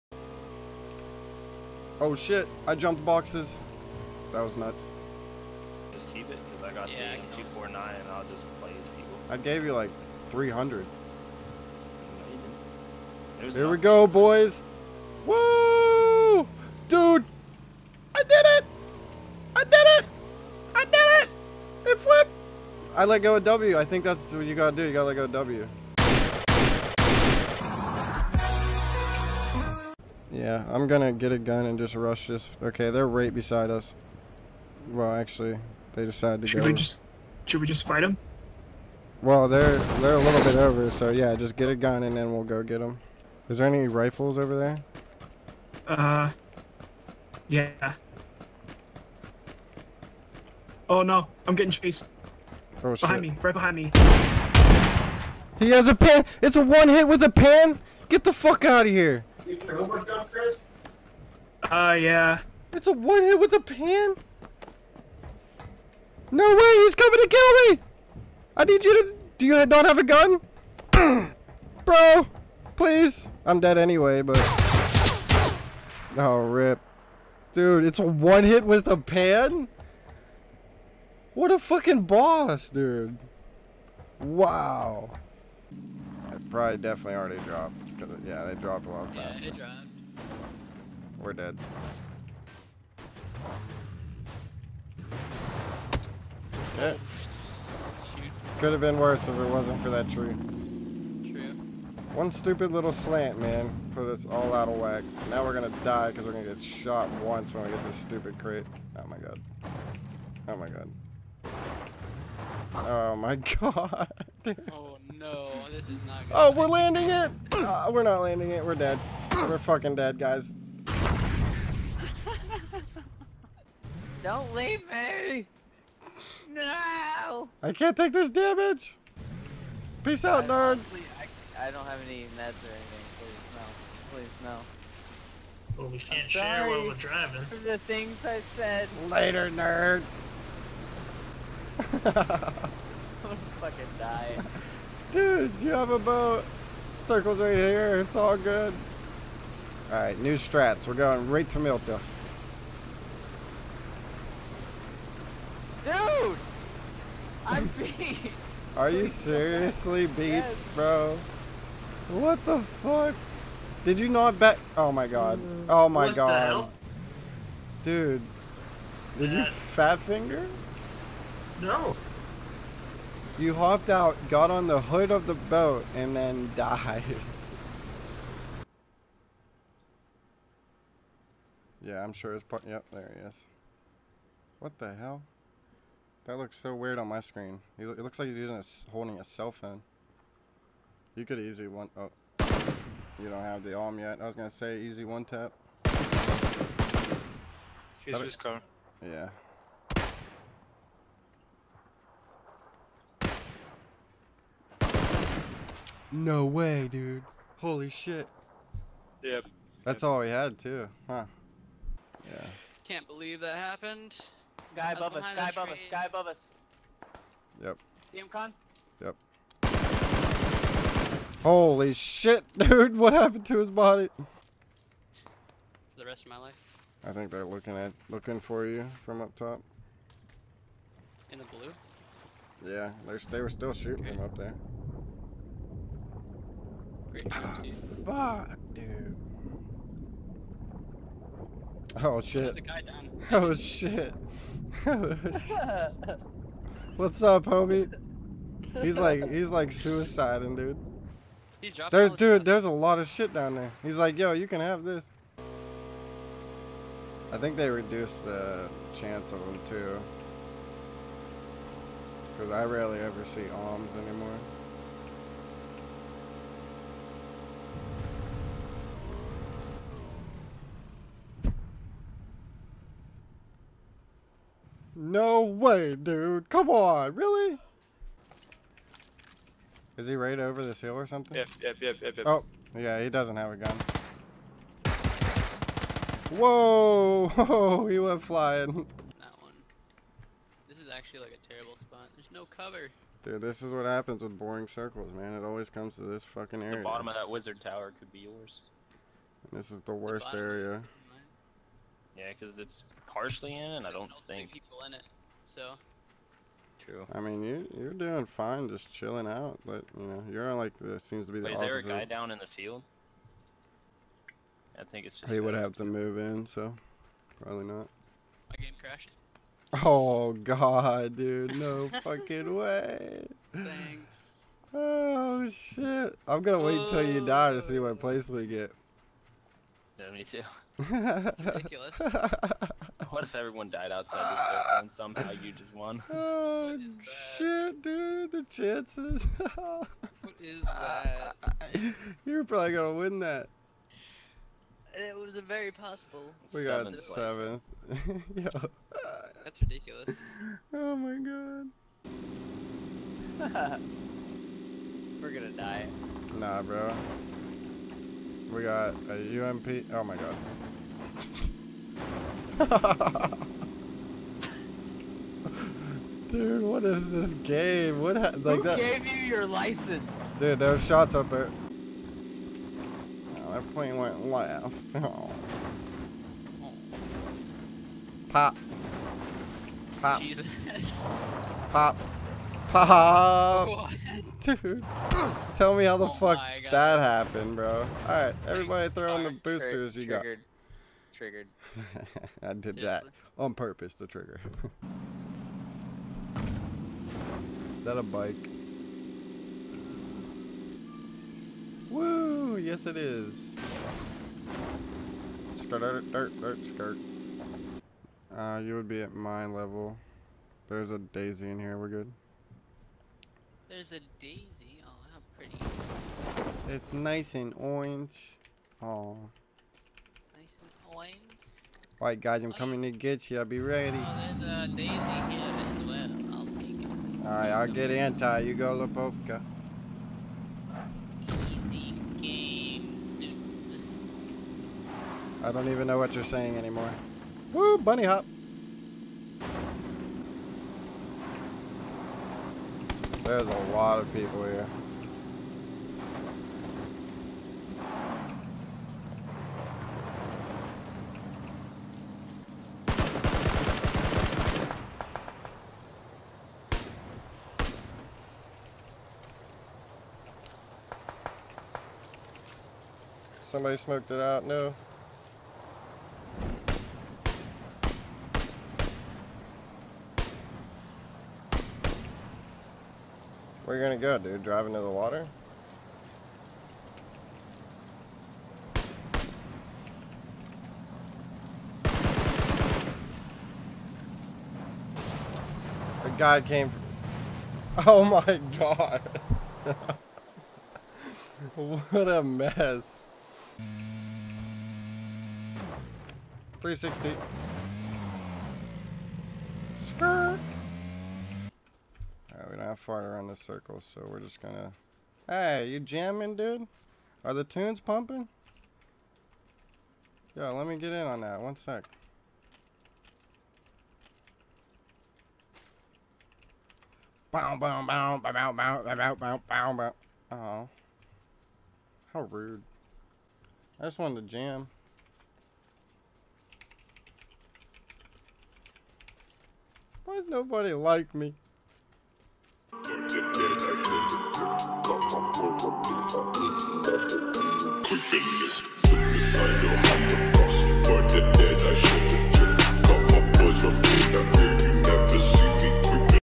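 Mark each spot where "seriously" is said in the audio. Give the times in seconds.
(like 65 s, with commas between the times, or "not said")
159 s, 392 s.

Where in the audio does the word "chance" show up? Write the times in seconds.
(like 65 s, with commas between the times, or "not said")
258 s, 338 s.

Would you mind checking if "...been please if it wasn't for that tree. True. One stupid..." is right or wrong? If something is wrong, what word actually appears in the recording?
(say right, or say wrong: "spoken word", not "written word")
wrong: "worse", not "please".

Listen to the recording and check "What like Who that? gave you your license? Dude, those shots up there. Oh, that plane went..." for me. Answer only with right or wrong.
right.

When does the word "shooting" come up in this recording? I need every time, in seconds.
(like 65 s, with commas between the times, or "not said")
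233 s.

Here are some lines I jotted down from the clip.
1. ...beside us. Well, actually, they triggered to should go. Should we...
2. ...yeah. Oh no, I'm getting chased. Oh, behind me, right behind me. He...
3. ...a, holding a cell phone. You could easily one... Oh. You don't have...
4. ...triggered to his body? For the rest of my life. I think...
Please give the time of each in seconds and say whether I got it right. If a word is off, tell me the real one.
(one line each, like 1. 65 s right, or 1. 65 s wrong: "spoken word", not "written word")
1. 33 s wrong: "decided", not "triggered"
2. 47 s right
3. 188 s right
4. 223 s wrong: "happened", not "triggered".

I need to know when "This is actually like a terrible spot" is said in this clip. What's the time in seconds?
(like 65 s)
290 s.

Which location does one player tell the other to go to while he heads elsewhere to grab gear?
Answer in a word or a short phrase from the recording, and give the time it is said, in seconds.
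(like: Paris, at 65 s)
Lipovka, at 428 s.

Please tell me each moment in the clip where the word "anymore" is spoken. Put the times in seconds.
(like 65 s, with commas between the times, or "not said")
263 s, 436 s.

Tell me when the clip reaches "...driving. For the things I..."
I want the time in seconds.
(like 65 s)
136 s.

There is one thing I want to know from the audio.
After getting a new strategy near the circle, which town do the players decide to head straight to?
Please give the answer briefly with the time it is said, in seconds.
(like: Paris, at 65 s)
Mylta, at 151 s.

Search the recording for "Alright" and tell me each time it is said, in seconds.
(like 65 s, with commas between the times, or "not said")
149 s, 388 s, 421 s, 427 s, 502 s.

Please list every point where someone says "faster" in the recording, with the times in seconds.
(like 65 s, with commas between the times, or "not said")
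89 s.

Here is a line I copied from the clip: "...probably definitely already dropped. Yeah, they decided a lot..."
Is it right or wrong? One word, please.
wrong.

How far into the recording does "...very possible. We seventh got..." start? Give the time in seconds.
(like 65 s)
345 s.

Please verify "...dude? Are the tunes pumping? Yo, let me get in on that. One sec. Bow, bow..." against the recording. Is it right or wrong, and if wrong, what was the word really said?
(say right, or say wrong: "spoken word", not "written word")
right.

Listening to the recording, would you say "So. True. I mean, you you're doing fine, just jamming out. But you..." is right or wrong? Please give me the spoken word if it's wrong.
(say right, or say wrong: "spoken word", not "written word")
wrong: "chilling", not "jamming".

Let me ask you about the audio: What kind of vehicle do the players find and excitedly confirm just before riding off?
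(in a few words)
Bike.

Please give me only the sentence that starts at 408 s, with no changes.
Uh, you would be at my level.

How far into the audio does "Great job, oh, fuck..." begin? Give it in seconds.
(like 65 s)
237 s.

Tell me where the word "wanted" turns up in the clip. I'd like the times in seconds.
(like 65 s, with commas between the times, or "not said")
523 s.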